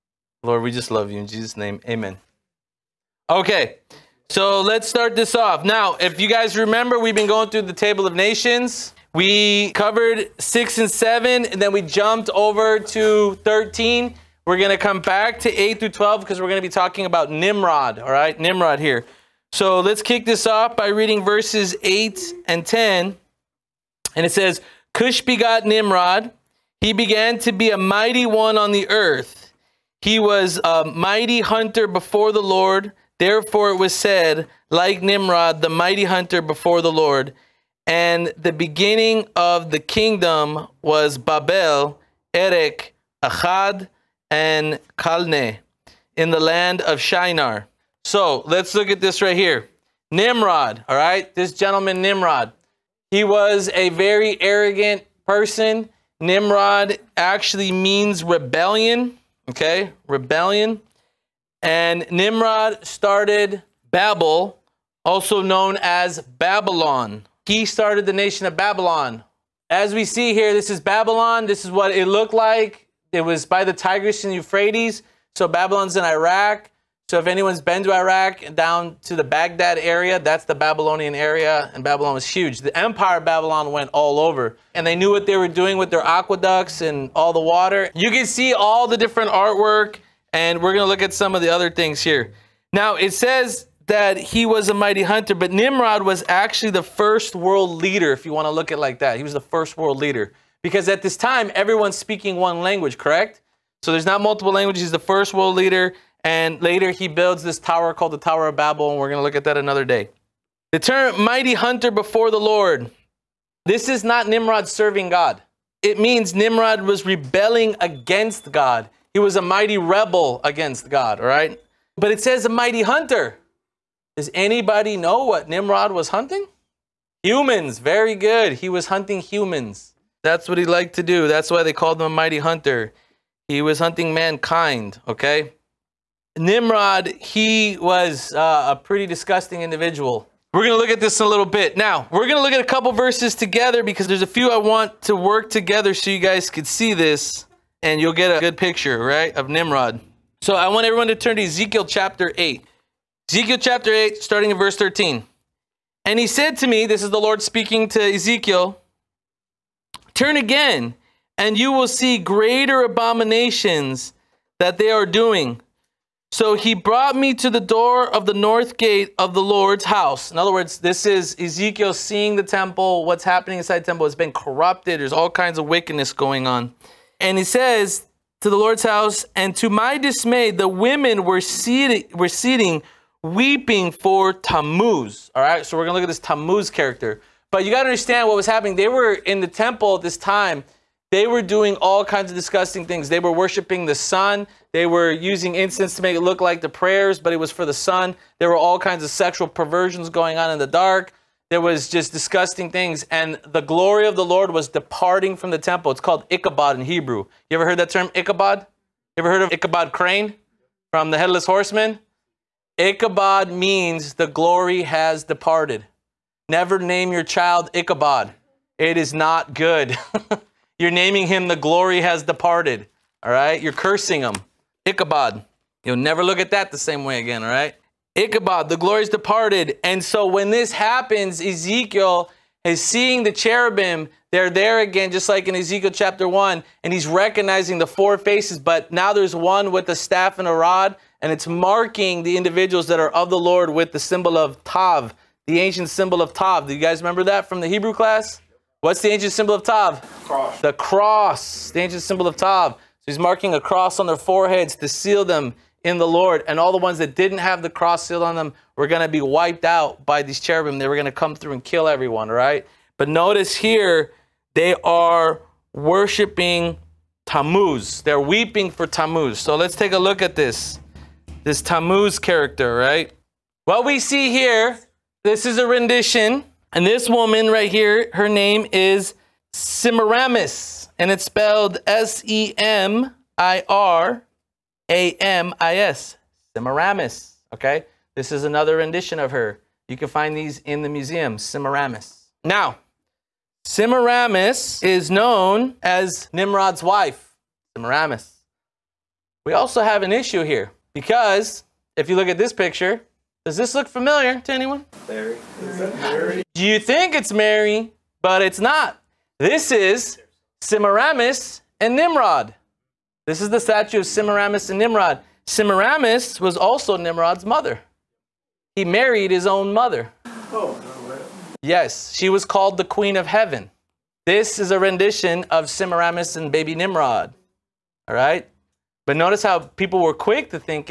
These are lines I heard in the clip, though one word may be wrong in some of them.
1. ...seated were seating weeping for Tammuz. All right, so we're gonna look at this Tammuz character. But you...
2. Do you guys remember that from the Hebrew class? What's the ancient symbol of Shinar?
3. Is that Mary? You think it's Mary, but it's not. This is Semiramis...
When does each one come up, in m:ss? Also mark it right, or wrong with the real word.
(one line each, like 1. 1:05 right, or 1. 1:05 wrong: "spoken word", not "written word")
1. 3:01 right
2. 4:06 wrong: "Tav", not "Shinar"
3. 5:05 right.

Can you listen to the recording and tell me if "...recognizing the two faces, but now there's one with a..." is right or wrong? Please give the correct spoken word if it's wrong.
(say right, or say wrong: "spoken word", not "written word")
wrong: "four", not "two".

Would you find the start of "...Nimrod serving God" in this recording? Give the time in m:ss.
1:54.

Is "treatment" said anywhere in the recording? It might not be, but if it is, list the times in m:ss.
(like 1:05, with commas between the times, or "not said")
not said.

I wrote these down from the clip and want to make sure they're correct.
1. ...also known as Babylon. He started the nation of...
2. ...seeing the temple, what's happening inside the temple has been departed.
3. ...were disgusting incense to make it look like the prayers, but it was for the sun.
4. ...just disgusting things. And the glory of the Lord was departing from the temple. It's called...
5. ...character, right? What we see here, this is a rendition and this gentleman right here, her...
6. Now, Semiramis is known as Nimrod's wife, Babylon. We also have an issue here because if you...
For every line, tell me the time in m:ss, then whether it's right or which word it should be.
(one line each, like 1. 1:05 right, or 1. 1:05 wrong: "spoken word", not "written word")
1. 1:05 right
2. 2:51 wrong: "corrupted", not "departed"
3. 3:14 wrong: "using", not "disgusting"
4. 3:21 right
5. 4:32 wrong: "woman", not "gentleman"
6. 4:52 wrong: "Semiramis", not "Babylon".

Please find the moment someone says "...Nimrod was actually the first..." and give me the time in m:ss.
1:35.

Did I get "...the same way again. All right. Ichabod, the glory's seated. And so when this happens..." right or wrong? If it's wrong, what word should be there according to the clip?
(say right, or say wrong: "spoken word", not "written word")
wrong: "departed", not "seated".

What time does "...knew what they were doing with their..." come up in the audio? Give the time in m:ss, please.
1:24.